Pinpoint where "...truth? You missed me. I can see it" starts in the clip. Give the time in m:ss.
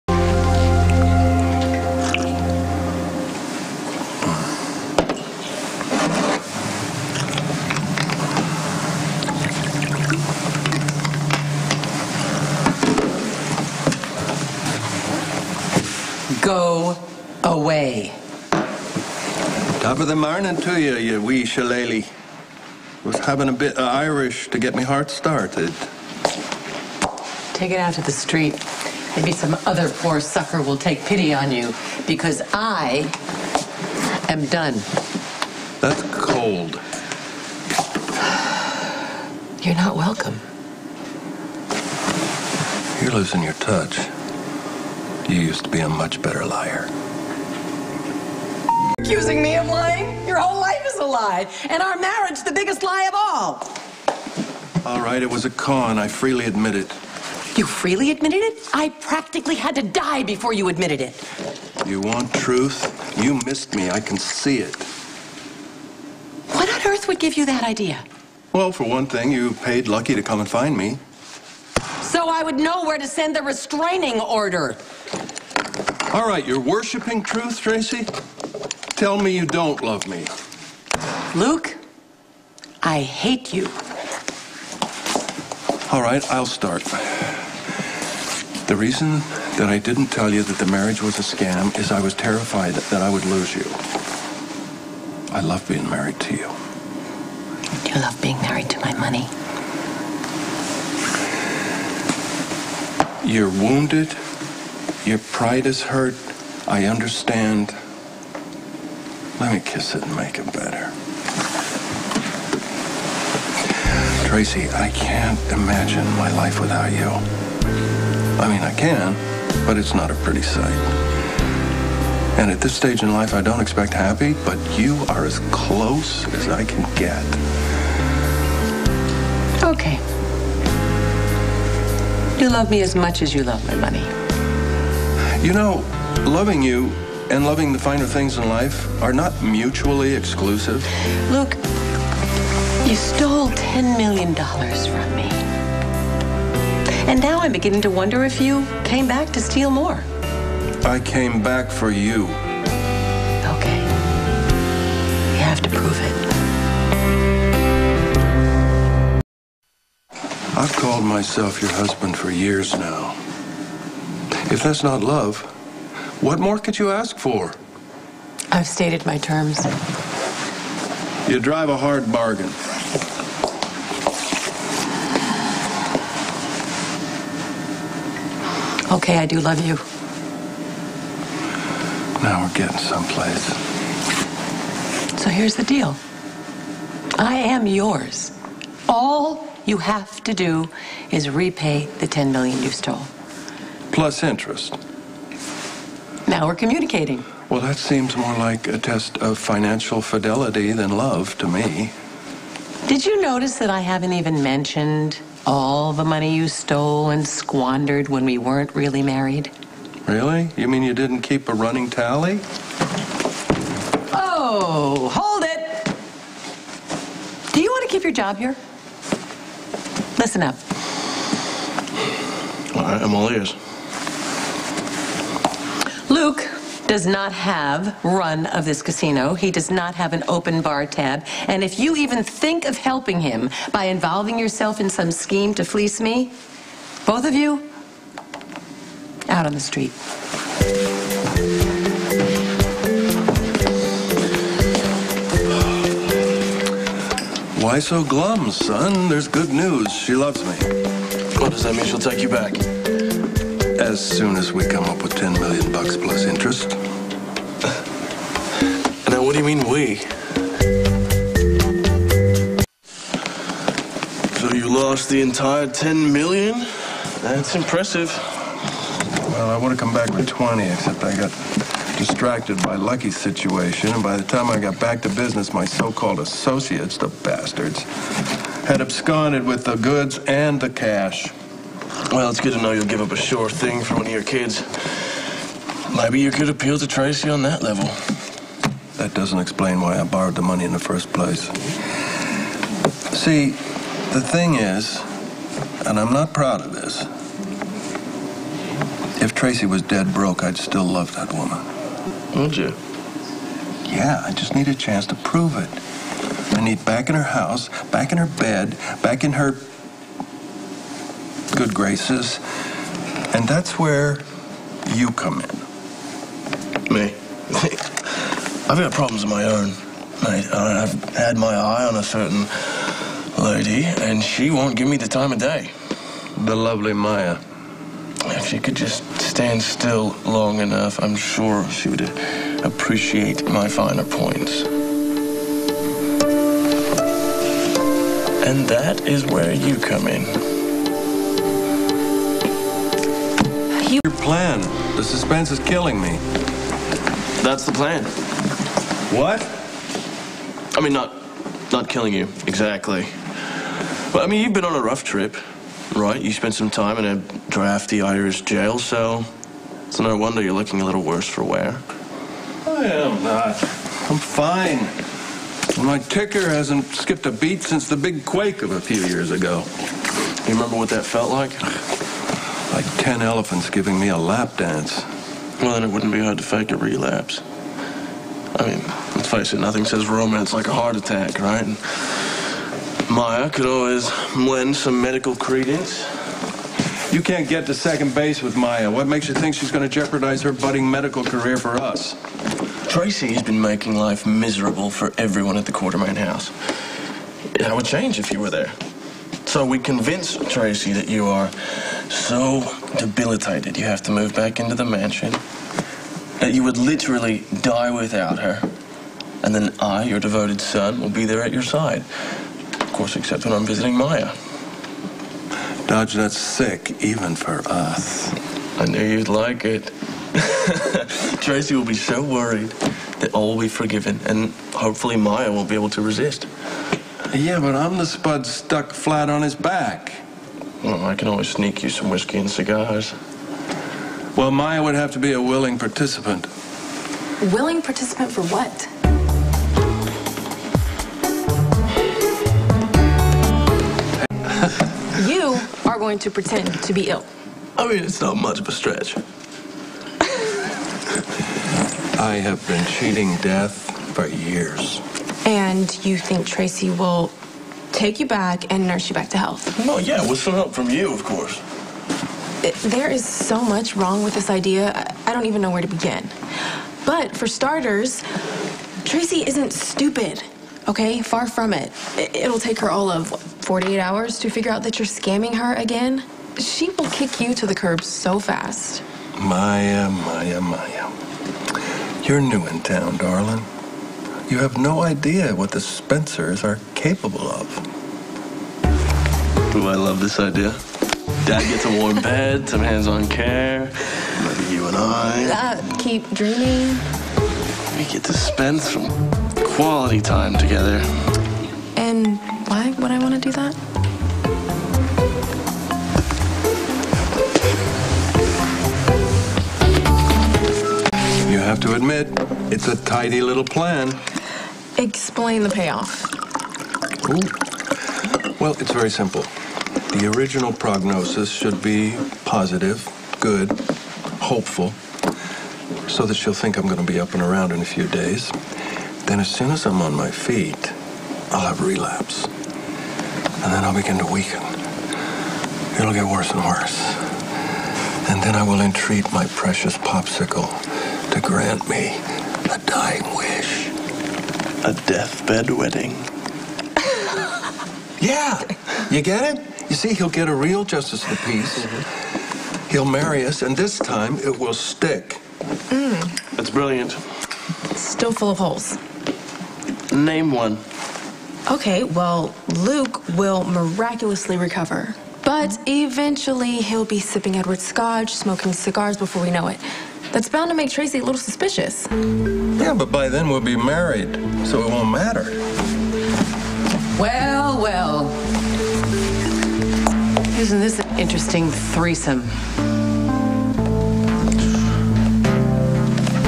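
1:02.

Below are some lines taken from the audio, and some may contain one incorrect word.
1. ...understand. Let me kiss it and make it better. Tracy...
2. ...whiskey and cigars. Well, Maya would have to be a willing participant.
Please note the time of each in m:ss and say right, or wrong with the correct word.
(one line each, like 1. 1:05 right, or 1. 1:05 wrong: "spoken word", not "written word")
1. 1:46 right
2. 7:12 right.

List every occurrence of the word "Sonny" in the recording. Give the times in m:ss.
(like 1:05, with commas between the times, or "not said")
not said.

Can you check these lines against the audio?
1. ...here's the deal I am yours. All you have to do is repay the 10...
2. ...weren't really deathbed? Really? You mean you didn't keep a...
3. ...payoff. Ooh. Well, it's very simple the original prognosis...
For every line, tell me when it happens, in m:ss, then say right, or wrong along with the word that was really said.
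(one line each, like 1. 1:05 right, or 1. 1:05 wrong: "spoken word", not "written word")
1. 3:05 right
2. 3:28 wrong: "married", not "deathbed"
3. 8:35 right.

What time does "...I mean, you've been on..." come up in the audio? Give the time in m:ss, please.
5:54.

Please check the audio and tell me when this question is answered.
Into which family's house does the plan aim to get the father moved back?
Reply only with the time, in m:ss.
6:35.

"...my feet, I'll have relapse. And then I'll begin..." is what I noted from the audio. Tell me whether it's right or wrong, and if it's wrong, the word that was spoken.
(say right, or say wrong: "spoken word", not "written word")
right.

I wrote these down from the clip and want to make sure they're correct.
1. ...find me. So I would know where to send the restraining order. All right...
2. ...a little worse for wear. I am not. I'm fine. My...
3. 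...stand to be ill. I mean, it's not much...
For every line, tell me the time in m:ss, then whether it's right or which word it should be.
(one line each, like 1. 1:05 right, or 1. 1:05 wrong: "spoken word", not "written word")
1. 1:10 right
2. 6:00 right
3. 7:26 wrong: "pretend", not "stand".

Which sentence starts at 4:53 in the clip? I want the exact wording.
See, the thing is, and I'm not proud of this, if Tracy was dead broke, I'd still love that woman.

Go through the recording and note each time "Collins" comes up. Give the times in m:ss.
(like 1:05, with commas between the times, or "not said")
not said.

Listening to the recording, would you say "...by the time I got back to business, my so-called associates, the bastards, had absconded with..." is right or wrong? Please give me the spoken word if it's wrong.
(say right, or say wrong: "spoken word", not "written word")
right.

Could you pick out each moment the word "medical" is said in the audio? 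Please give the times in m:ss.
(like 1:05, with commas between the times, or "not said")
6:25, 6:30.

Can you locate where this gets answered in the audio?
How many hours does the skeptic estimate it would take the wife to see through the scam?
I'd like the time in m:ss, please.
7:53.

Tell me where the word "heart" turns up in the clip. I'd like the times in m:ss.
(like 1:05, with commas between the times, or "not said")
0:24, 6:20.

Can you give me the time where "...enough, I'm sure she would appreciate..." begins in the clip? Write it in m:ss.
5:30.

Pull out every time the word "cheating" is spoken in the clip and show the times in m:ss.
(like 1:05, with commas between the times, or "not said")
7:32.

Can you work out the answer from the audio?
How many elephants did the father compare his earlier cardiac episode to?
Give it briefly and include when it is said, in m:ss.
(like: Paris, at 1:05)
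10, at 6:12.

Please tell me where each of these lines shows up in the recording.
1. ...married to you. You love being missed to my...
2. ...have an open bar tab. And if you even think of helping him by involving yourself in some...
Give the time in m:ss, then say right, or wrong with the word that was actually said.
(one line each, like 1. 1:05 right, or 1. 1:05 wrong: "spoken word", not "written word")
1. 1:35 wrong: "married", not "missed"
2. 3:49 right.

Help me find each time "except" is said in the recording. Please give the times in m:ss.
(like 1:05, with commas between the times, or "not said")
4:30, 6:53.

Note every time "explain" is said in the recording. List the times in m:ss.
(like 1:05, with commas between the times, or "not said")
4:49, 8:34.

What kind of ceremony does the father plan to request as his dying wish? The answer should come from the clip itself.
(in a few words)
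A deathbed wedding.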